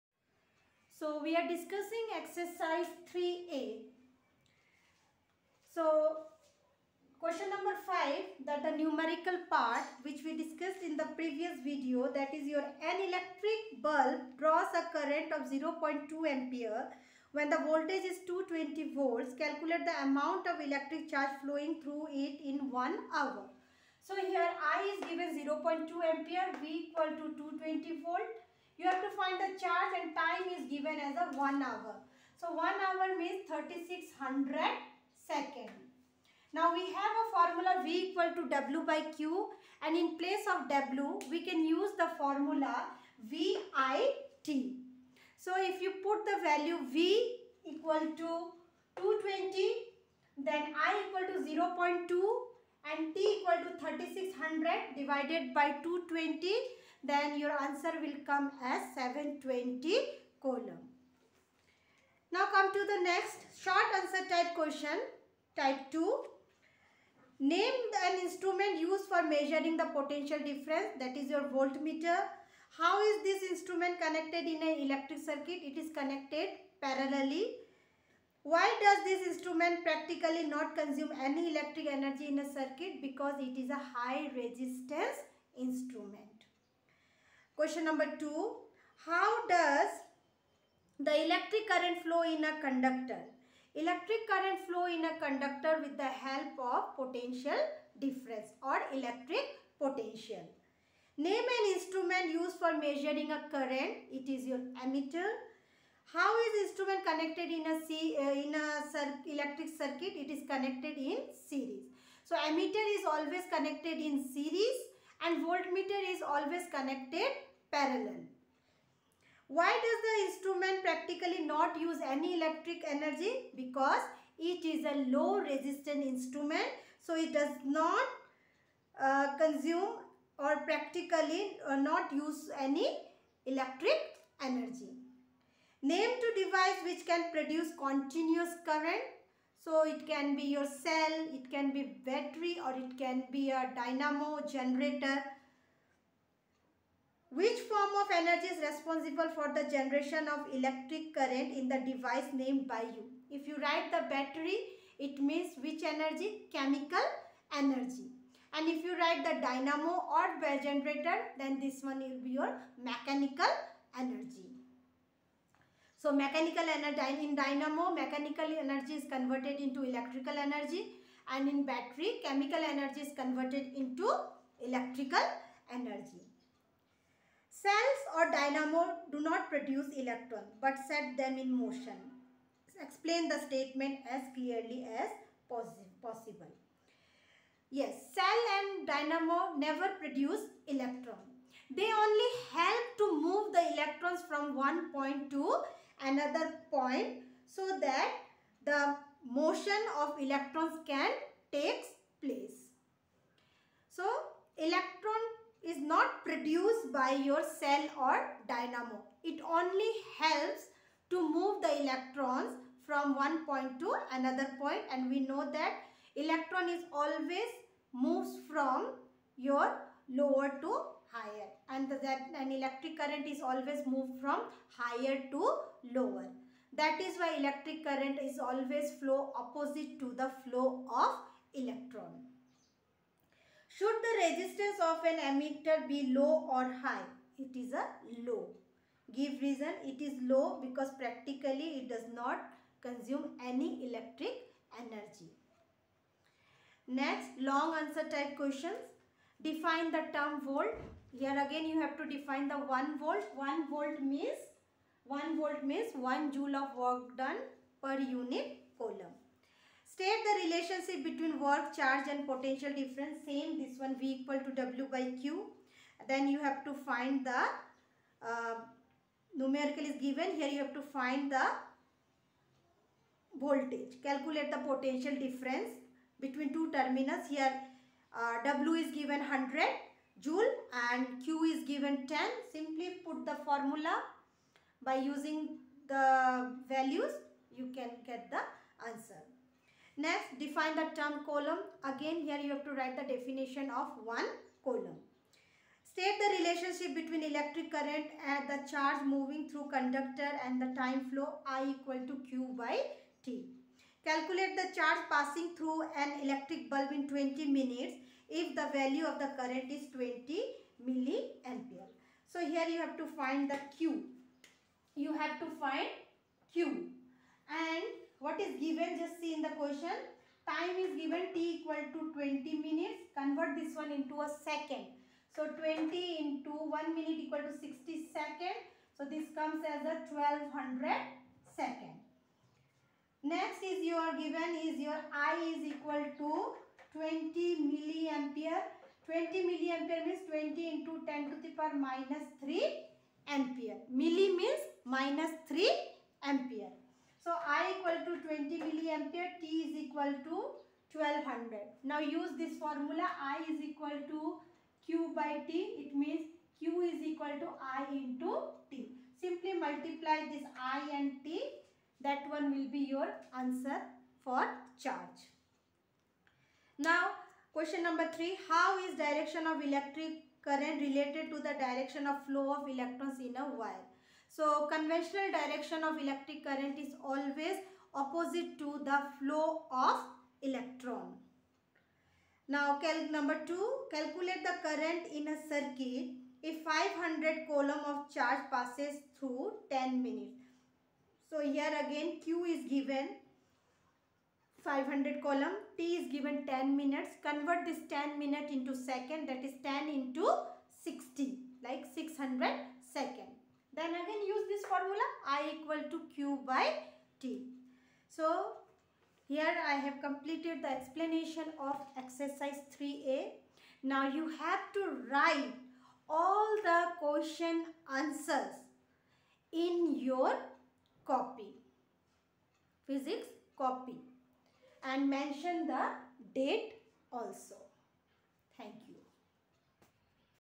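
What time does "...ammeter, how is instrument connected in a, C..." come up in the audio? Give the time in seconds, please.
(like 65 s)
104 s.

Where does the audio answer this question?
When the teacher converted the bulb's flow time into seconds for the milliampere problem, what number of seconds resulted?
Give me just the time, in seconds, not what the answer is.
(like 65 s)
330 s.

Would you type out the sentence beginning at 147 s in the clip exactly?
Which form of energy is responsible for the generation of electric current in the device named by you?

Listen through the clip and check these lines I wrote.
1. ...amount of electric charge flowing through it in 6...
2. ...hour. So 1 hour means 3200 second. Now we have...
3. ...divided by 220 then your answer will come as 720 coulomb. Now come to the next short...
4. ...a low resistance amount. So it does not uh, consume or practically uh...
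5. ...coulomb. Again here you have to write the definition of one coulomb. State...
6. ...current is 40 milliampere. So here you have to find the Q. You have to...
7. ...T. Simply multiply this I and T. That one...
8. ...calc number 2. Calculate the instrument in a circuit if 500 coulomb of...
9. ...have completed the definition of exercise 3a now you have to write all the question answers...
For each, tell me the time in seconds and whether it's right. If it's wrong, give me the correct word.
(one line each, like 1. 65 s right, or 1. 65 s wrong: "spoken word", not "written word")
1. 20 s wrong: "1", not "6"
2. 31 s wrong: "3600", not "3200"
3. 54 s right
4. 124 s wrong: "instrument", not "amount"
5. 291 s right
6. 309 s wrong: "20", not "40"
7. 358 s right
8. 382 s wrong: "current", not "instrument"
9. 409 s wrong: "explanation", not "definition".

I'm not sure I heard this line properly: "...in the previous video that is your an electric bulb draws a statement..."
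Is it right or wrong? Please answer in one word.
wrong.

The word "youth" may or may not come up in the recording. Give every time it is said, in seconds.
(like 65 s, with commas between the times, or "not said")
not said.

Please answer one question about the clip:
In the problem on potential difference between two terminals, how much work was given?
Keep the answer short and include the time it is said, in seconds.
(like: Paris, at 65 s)
100 joule, at 279 s.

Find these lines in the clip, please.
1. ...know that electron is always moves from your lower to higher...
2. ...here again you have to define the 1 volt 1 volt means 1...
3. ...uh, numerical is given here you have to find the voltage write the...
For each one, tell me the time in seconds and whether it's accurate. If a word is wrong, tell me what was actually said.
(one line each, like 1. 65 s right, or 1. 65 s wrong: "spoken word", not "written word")
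1. 215 s right
2. 251 s right
3. 268 s wrong: "calculate", not "write".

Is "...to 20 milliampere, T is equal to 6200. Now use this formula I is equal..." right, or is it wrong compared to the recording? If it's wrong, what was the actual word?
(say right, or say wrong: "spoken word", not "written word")
wrong: "1200", not "6200".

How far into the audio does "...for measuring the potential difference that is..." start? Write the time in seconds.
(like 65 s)
69 s.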